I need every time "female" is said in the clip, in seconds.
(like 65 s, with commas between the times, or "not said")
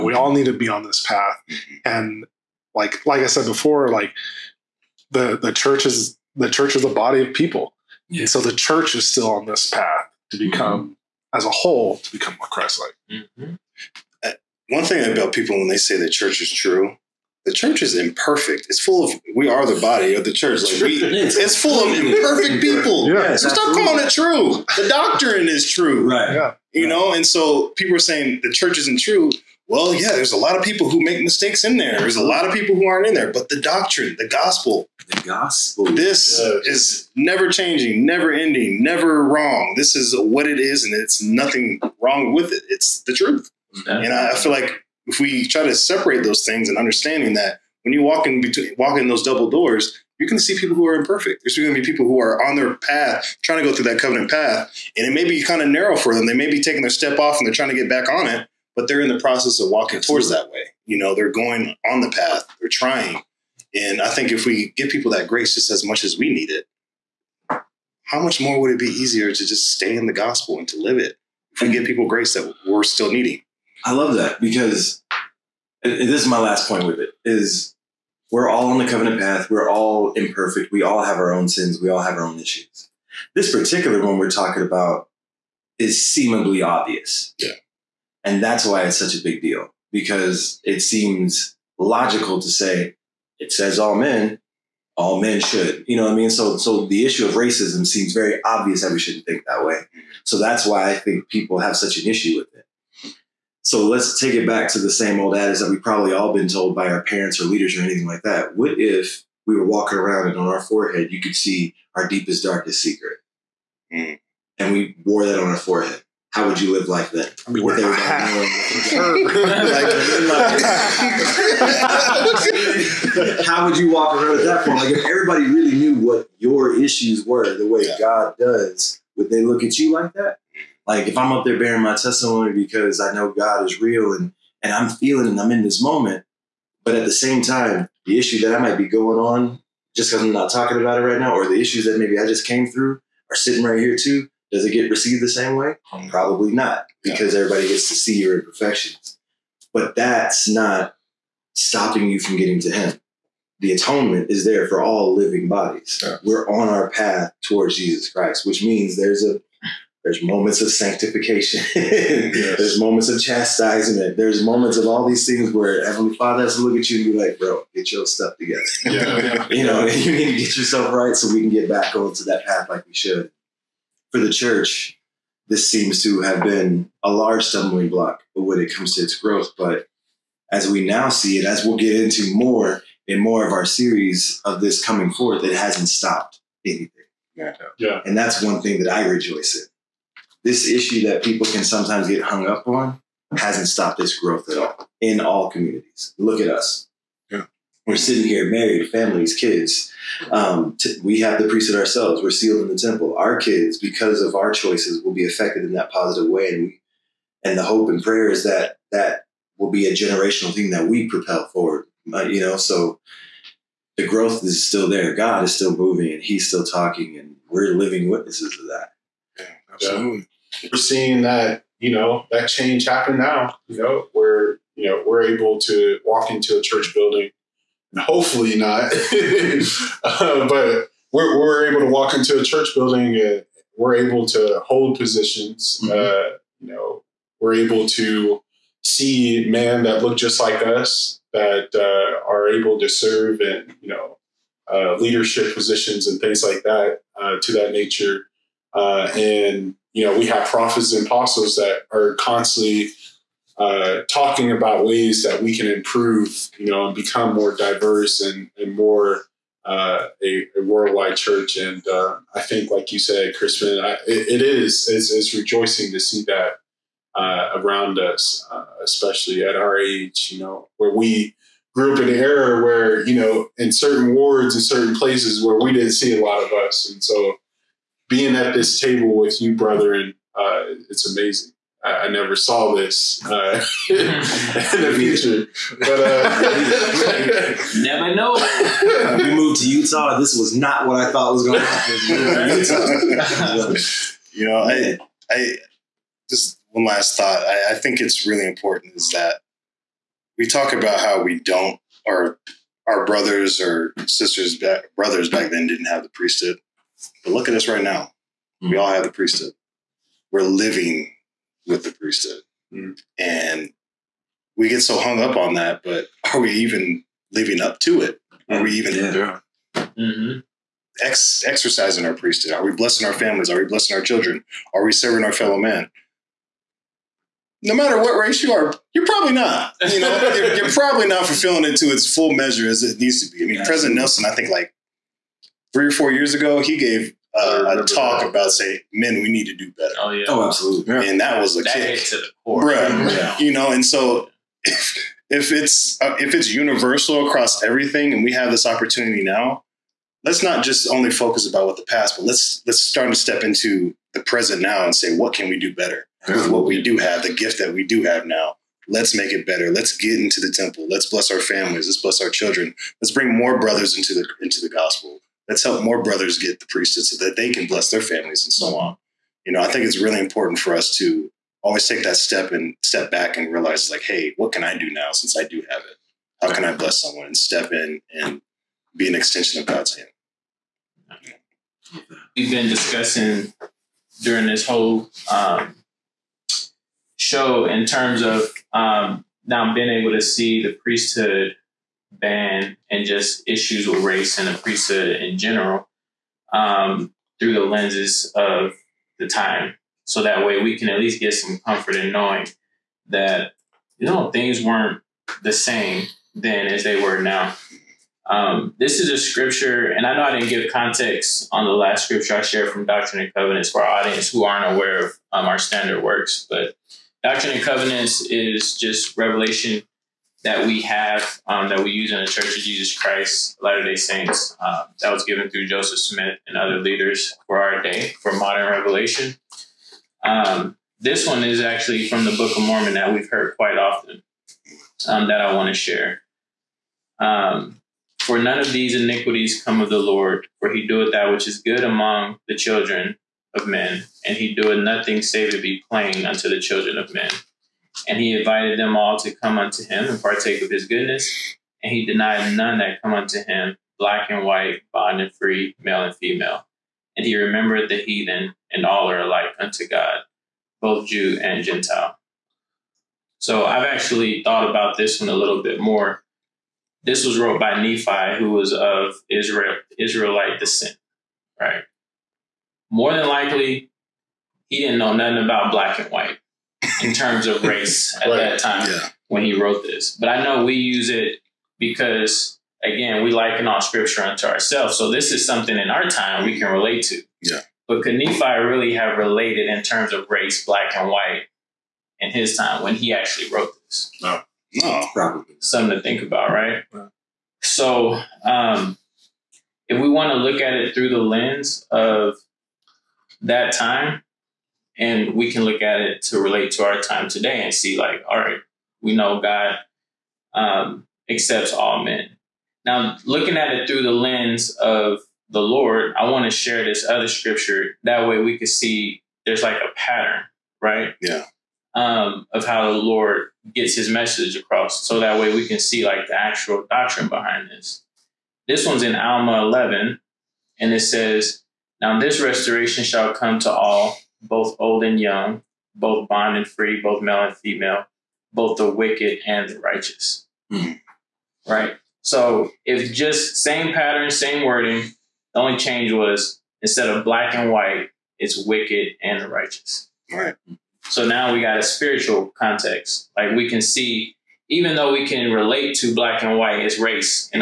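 456 s, 537 s.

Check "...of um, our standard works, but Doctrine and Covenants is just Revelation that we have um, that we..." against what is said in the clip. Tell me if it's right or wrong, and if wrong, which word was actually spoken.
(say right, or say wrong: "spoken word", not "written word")
right.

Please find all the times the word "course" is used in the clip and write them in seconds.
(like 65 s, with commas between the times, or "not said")
not said.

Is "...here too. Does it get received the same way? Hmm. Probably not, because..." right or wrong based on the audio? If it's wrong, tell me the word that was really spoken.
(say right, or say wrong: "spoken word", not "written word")
right.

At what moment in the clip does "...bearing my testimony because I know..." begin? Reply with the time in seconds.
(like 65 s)
131 s.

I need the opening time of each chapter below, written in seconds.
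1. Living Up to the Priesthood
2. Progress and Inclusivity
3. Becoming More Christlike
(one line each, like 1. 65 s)
1. 298 s
2. 476 s
3. 187 s.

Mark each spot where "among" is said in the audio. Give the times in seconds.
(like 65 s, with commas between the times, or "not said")
441 s.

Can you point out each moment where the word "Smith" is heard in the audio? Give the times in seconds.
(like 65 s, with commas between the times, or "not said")
425 s.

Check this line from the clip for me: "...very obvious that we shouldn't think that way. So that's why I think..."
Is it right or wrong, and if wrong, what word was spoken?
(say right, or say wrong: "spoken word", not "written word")
right.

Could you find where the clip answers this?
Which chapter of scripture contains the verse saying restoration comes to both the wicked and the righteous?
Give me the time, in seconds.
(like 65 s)
529 s.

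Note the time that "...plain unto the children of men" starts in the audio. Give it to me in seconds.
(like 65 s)
445 s.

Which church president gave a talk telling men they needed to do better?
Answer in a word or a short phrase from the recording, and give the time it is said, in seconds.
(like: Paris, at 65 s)
President Nelson, at 333 s.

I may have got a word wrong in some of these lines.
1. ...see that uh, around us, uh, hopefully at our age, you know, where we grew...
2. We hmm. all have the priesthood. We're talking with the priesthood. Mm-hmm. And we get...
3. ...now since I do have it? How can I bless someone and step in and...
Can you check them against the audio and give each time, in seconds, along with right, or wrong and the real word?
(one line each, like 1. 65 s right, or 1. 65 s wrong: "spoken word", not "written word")
1. 265 s wrong: "especially", not "hopefully"
2. 308 s wrong: "living", not "talking"
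3. 374 s right.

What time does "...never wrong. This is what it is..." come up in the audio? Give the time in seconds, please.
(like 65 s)
38 s.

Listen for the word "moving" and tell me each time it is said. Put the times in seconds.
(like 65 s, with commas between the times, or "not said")
215 s.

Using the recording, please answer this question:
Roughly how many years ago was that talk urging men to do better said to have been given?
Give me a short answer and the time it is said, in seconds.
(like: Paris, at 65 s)
3 or 4 years, at 335 s.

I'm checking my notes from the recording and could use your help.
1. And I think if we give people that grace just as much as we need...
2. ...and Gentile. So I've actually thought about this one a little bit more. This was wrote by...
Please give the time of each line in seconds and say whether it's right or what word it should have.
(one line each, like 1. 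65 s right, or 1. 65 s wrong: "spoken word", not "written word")
1. 63 s right
2. 461 s right.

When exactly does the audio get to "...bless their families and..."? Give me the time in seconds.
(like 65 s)
367 s.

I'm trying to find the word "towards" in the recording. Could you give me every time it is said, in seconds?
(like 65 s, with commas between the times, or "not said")
60 s, 157 s.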